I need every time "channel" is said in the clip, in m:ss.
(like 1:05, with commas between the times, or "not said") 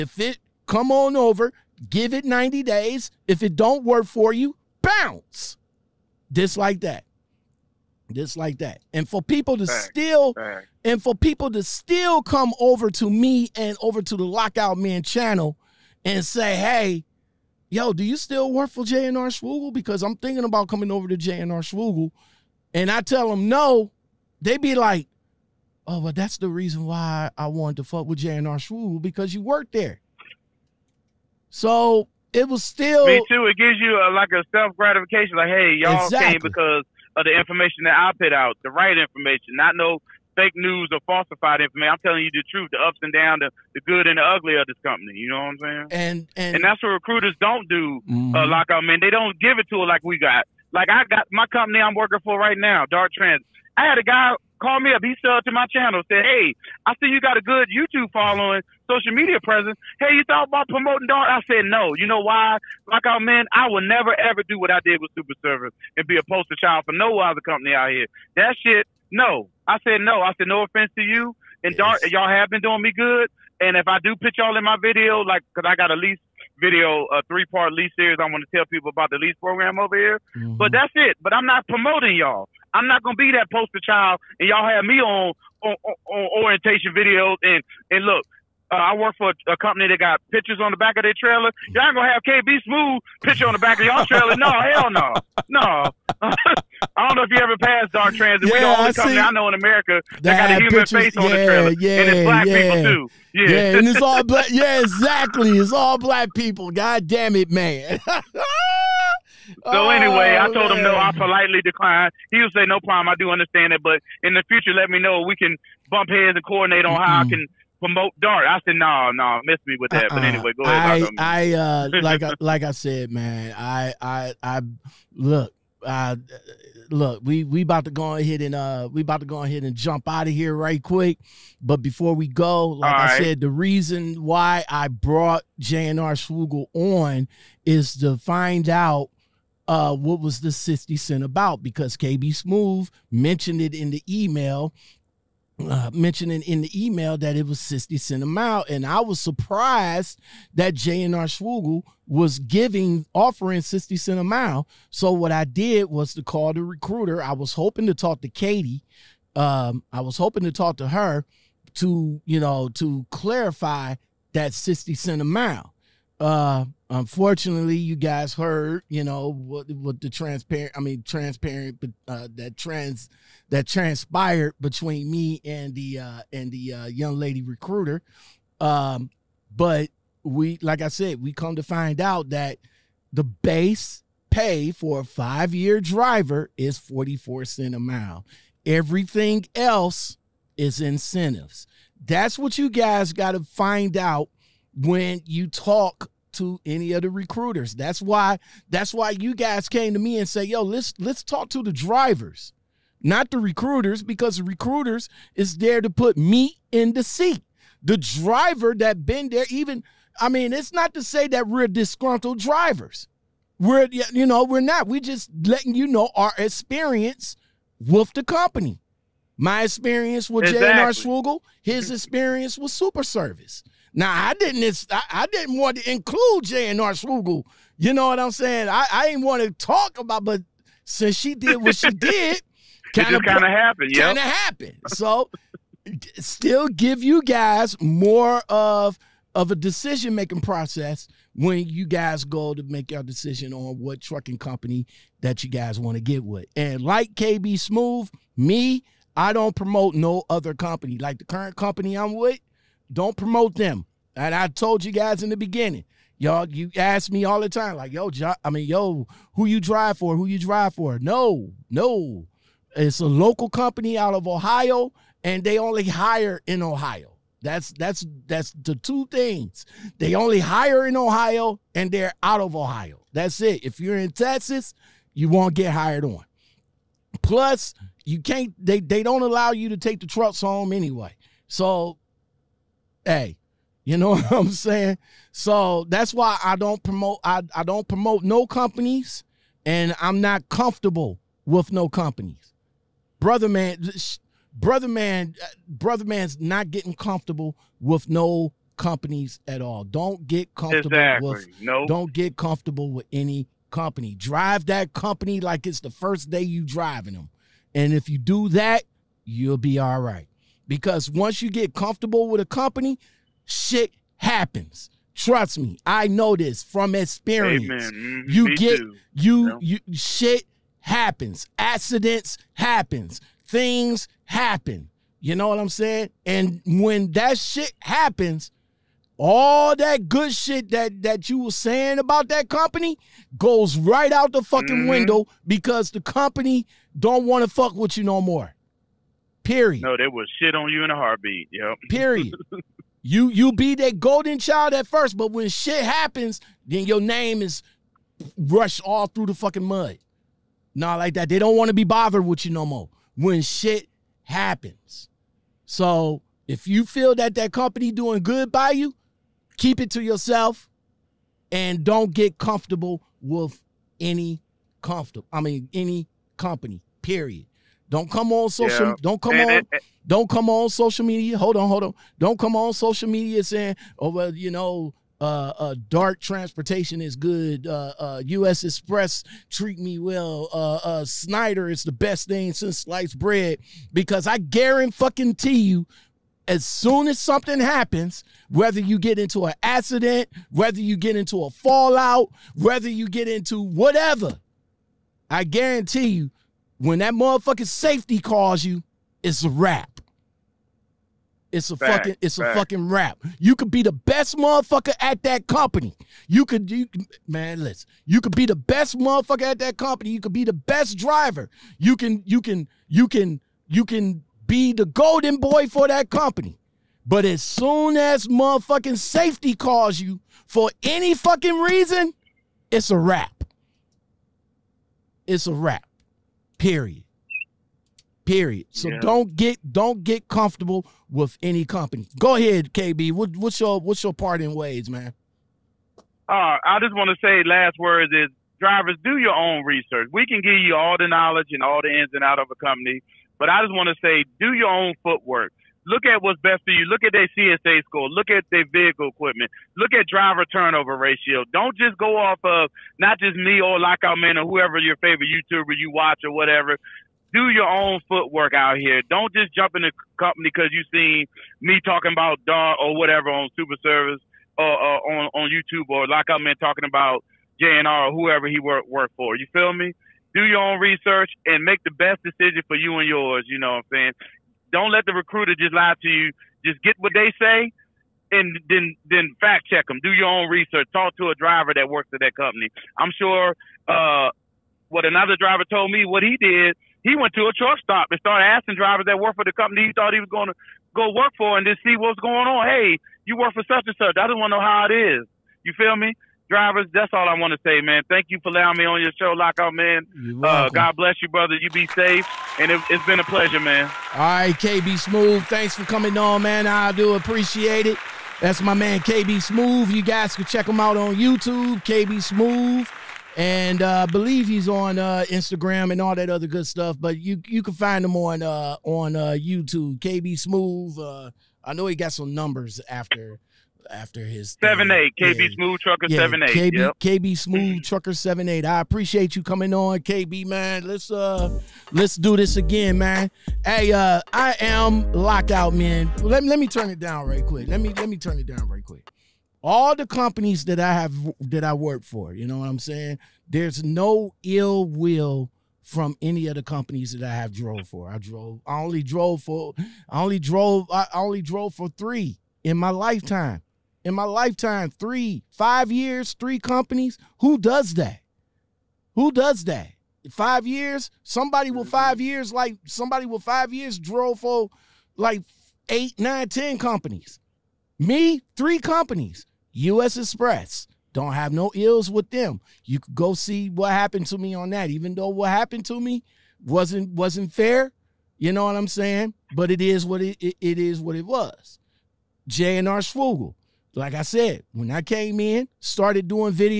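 0:15, 0:55.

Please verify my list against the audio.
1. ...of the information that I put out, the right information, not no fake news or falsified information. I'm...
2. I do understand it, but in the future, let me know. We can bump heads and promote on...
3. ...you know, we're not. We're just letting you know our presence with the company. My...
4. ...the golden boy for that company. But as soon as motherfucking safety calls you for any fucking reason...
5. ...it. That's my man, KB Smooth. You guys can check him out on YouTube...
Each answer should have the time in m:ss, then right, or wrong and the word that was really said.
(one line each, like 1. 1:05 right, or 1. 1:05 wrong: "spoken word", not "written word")
1. 0:37 right
2. 1:53 wrong: "coordinate", not "promote"
3. 3:33 wrong: "experience", not "presence"
4. 6:54 right
5. 8:27 right.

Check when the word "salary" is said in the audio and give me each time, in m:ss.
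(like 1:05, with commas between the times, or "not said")
not said.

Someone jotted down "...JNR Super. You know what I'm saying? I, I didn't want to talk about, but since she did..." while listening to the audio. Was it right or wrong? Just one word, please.
wrong.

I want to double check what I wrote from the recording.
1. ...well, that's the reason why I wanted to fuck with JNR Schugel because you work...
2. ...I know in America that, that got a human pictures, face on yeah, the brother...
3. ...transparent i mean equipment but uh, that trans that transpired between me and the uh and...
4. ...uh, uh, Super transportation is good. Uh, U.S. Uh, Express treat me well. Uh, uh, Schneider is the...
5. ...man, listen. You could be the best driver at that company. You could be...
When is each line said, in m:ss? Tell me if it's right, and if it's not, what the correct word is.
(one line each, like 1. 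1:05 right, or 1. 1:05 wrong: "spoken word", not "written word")
1. 0:26 right
2. 1:39 wrong: "trailer", not "brother"
3. 2:50 wrong: "transparent", not "equipment"
4. 6:15 wrong: "Dart", not "Super"
5. 6:47 wrong: "motherfucker", not "driver".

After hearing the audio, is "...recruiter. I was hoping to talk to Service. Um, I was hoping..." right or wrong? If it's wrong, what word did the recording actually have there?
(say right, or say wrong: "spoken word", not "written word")
wrong: "Katie", not "Service".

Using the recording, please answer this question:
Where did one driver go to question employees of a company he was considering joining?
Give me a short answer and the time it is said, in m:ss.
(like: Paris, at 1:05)
a truck stop, at 8:07.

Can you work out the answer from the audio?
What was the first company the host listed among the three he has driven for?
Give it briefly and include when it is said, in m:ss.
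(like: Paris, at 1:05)
US Express, at 9:29.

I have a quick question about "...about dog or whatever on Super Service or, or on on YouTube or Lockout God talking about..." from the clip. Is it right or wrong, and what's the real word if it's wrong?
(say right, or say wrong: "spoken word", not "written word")
wrong: "Man", not "God".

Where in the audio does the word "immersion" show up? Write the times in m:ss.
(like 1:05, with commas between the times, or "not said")
not said.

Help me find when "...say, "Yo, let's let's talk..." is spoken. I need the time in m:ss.
3:20.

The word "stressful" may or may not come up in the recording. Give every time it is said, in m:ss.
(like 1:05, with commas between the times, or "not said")
not said.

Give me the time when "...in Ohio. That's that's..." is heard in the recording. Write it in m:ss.
4:26.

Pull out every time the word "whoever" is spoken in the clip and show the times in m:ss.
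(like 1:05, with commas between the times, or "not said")
7:34, 7:48.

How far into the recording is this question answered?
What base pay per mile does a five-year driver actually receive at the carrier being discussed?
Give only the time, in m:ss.
3:06.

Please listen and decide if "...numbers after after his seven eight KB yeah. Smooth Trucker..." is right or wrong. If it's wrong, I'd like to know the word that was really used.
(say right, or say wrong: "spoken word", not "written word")
right.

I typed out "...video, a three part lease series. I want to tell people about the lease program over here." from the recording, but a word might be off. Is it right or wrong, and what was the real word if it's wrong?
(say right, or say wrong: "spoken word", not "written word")
right.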